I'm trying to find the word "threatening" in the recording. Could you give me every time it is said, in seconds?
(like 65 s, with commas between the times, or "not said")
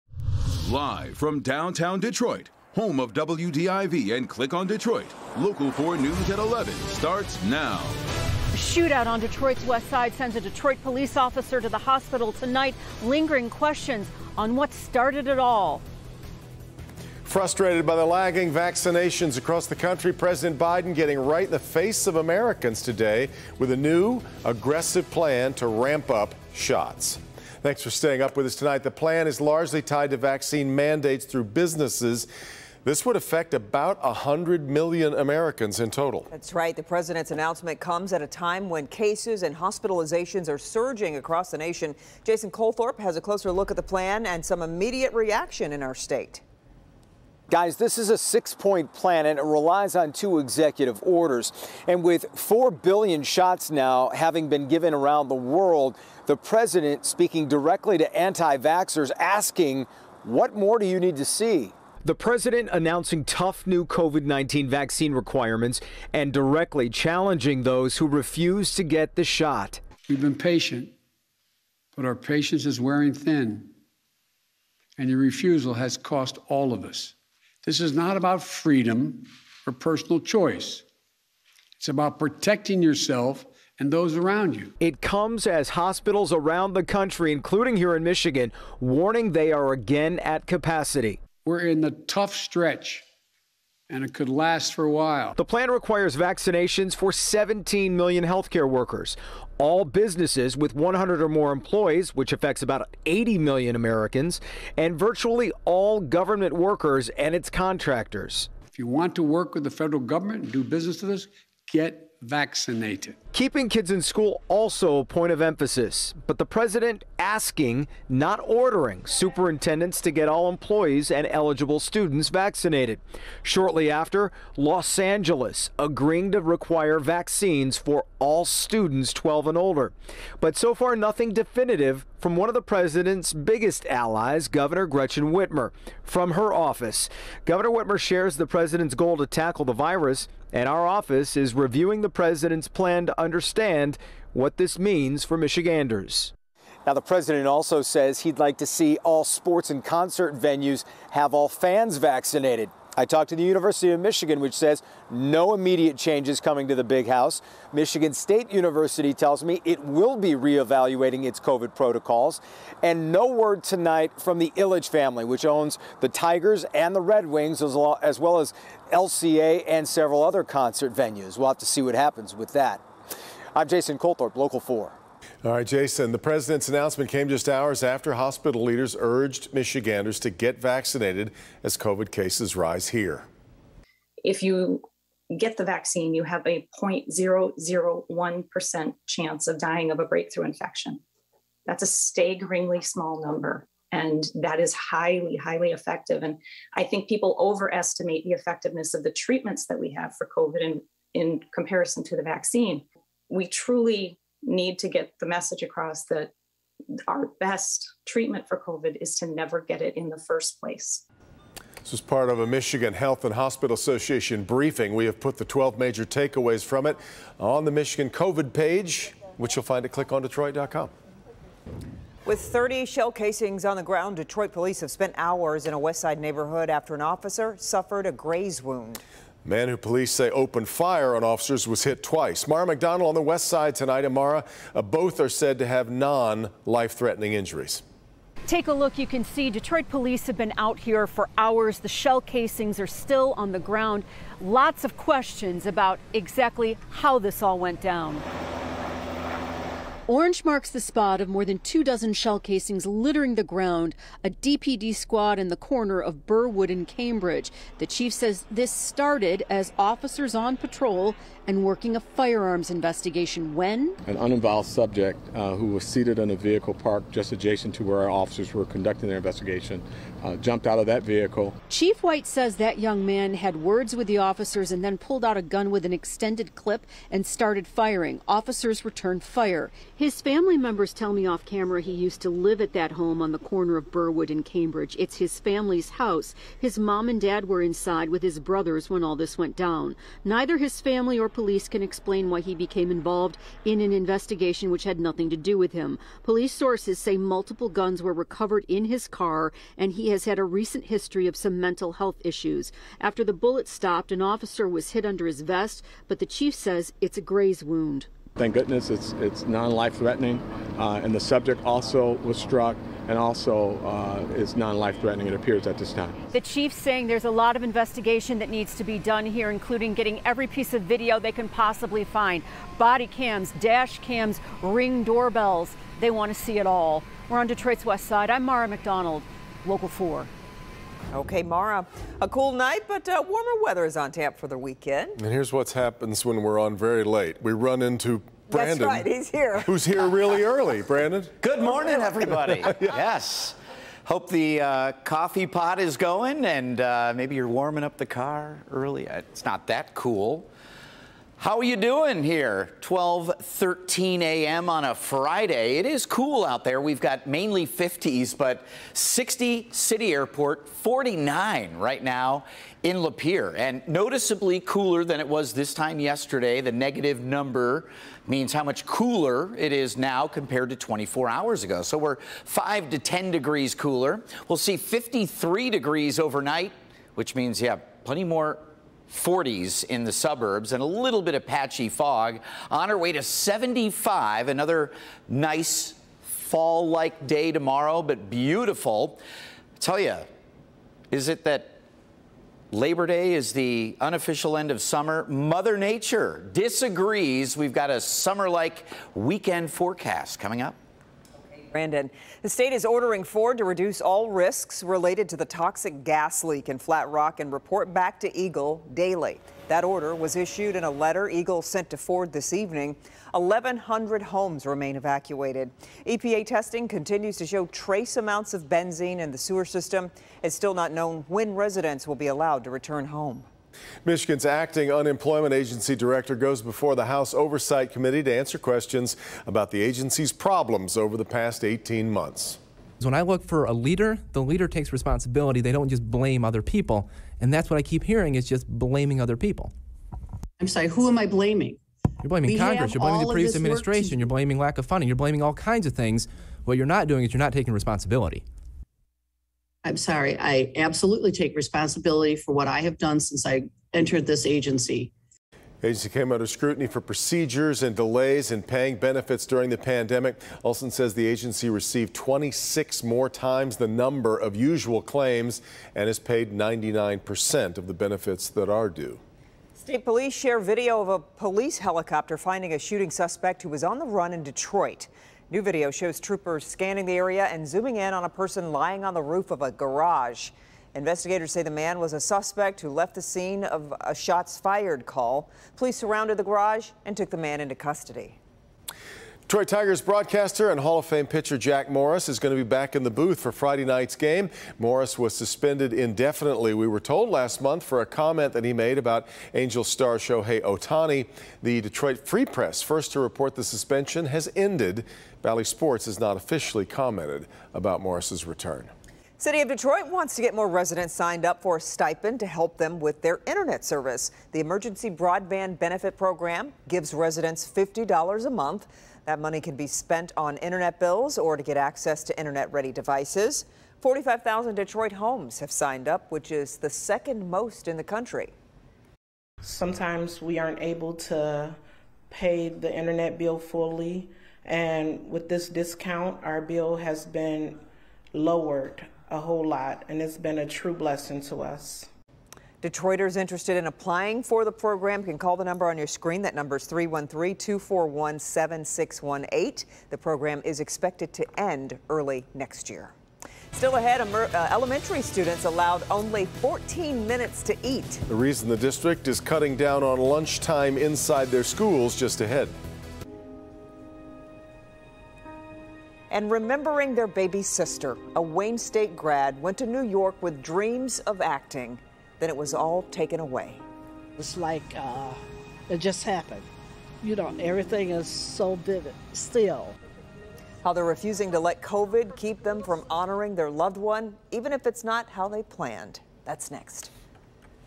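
235 s, 309 s, 315 s.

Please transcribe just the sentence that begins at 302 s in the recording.
After the bullet stopped, an officer was hit under his vest, but the chief says it's a graze wound.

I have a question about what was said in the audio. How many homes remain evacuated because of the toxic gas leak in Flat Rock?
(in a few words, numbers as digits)
1,100.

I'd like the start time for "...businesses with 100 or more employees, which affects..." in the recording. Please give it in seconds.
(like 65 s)
99 s.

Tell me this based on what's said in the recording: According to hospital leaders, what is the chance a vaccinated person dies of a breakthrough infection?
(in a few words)
0.001%.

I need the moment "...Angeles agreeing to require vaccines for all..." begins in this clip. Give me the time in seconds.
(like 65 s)
124 s.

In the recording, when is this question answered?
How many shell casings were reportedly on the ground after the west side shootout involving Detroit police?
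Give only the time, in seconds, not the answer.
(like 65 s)
222 s.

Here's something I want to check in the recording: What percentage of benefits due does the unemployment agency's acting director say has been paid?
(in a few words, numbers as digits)
99%.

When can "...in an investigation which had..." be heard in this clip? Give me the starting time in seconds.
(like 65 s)
293 s.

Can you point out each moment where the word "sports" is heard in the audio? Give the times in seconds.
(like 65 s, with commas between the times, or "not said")
149 s, 505 s.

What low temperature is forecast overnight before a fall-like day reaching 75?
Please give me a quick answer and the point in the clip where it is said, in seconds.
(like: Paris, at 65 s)
53 degrees, at 374 s.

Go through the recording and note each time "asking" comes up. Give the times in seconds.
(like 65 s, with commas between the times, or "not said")
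59 s, 117 s.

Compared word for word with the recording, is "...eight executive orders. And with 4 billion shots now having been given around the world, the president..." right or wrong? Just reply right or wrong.
wrong.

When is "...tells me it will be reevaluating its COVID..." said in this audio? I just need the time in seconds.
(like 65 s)
159 s.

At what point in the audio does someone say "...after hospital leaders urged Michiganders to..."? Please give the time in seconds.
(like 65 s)
177 s.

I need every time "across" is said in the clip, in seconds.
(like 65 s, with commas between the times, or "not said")
19 s, 41 s, 205 s.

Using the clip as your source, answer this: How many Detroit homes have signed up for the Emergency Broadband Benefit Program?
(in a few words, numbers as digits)
45,000.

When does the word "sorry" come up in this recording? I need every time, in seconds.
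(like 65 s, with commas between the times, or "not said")
440 s, 449 s.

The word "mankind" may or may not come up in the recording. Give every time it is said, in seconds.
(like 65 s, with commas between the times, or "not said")
not said.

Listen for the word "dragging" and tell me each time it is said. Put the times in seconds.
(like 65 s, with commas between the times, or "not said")
not said.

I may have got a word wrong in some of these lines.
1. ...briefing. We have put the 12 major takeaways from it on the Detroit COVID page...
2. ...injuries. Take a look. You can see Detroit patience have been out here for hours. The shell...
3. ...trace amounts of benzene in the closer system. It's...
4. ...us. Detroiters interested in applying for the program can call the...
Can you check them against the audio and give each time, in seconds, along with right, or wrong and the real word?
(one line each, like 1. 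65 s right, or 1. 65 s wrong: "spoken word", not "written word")
1. 214 s wrong: "Michigan", not "Detroit"
2. 237 s wrong: "police", not "patience"
3. 417 s wrong: "sewer", not "closer"
4. 541 s right.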